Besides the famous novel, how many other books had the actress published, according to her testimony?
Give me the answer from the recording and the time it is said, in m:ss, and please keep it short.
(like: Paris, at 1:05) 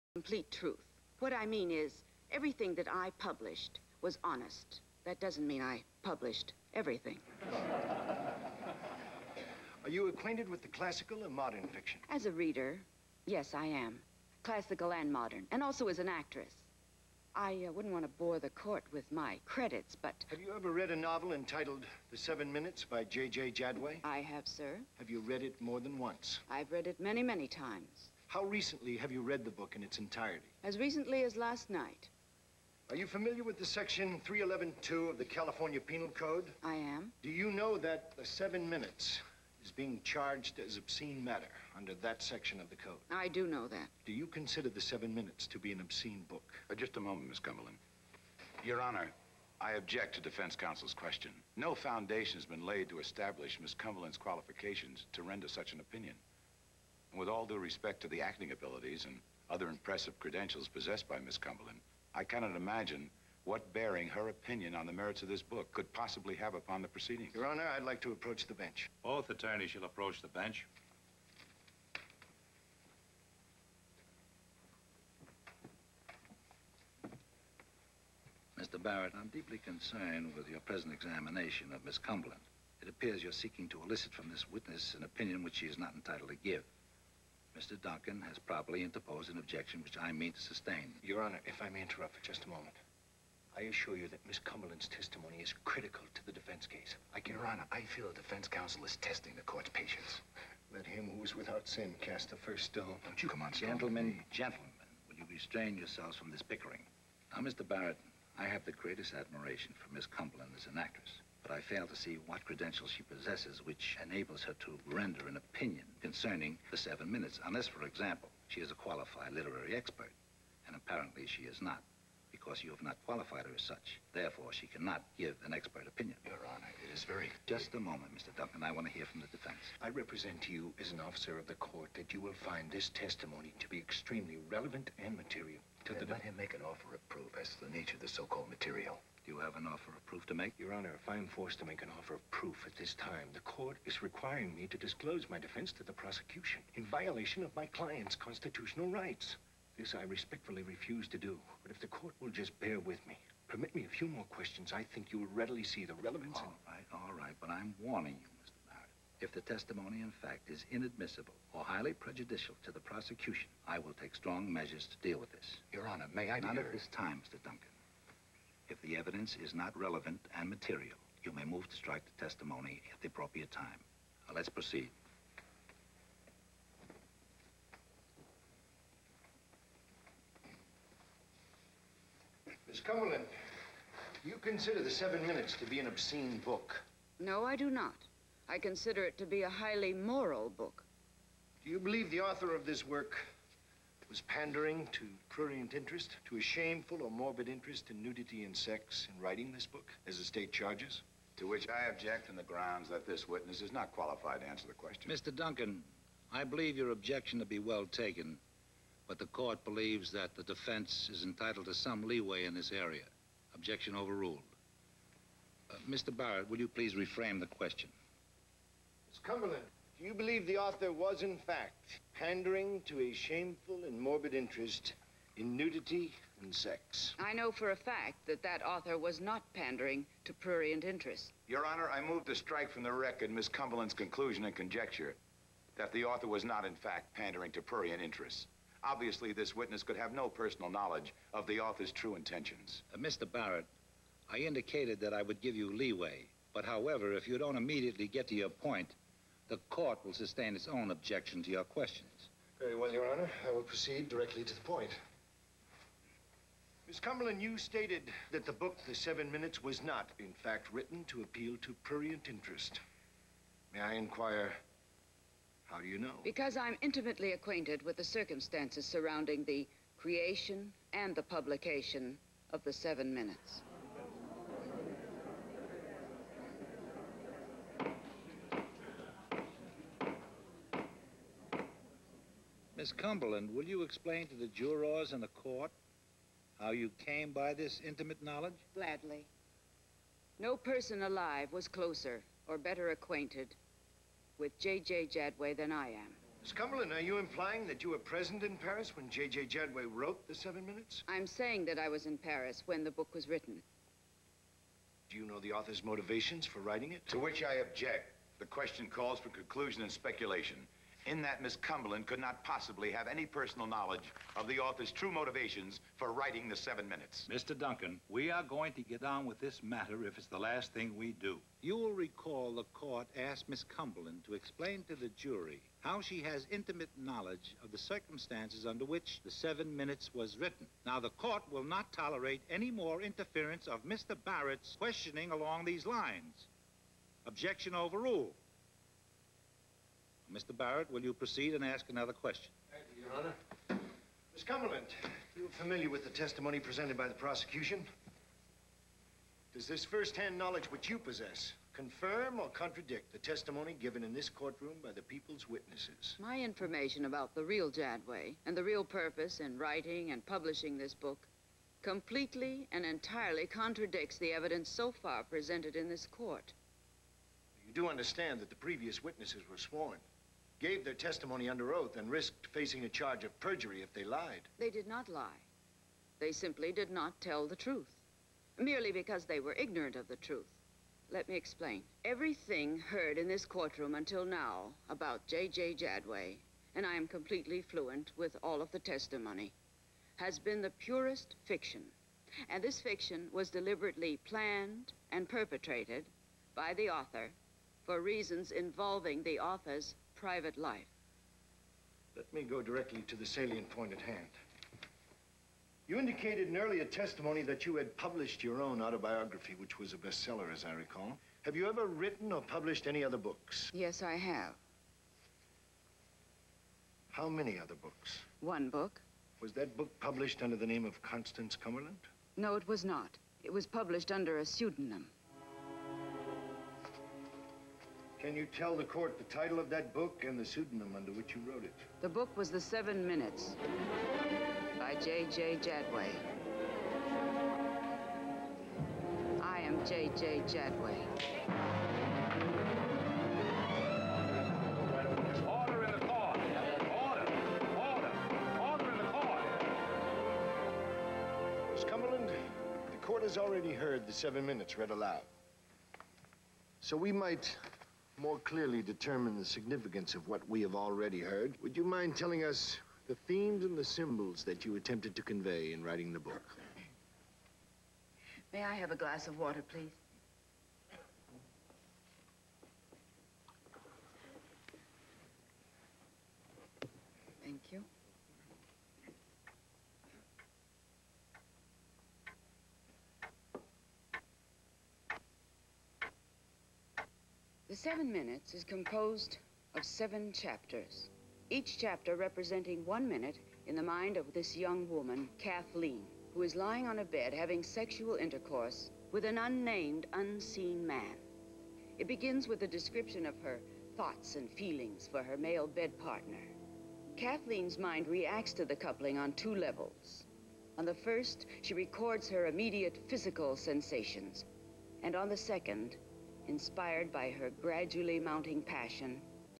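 1, at 6:58.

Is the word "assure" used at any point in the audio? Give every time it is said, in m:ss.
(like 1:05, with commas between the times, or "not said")
1:33.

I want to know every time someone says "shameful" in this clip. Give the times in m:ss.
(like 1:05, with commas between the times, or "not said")
3:16, 3:43.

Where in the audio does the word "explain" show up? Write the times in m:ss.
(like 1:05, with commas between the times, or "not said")
4:43, 5:24, 6:21.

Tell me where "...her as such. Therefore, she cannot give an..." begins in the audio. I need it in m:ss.
2:03.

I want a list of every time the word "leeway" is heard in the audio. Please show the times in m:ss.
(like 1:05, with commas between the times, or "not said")
3:32, 4:05.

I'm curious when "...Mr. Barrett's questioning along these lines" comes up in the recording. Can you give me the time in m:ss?
5:33.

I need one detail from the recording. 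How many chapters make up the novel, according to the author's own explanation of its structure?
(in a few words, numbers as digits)
7.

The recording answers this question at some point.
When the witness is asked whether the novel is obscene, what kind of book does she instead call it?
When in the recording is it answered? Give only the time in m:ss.
3:09.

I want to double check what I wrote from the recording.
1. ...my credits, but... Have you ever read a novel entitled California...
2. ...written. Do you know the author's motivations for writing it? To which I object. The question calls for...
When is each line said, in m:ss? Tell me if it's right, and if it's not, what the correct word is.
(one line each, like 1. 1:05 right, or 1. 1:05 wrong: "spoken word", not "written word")
1. 0:19 wrong: "The", not "California"
2. 5:03 right.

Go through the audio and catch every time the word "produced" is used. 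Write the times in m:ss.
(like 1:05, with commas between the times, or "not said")
not said.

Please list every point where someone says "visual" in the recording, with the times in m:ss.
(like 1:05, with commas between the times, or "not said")
not said.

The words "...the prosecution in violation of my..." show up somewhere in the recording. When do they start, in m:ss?
2:25.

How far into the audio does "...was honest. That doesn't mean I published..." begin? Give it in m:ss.
0:04.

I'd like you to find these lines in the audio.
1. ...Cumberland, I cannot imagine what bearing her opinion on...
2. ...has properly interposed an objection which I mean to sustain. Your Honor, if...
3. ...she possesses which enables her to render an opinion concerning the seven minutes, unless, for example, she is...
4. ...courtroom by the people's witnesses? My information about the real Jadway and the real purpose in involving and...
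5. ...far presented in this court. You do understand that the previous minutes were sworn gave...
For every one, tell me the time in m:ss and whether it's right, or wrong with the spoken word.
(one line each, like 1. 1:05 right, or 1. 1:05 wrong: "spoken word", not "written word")
1. 1:01 right
2. 1:28 right
3. 1:52 right
4. 5:54 wrong: "writing", not "involving"
5. 6:04 wrong: "witnesses", not "minutes".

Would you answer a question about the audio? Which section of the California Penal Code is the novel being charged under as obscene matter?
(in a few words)
311.2.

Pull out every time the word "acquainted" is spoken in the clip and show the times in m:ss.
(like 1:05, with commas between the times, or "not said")
0:10, 4:27, 4:52.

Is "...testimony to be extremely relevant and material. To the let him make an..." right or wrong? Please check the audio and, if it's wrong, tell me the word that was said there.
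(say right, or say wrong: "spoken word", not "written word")
right.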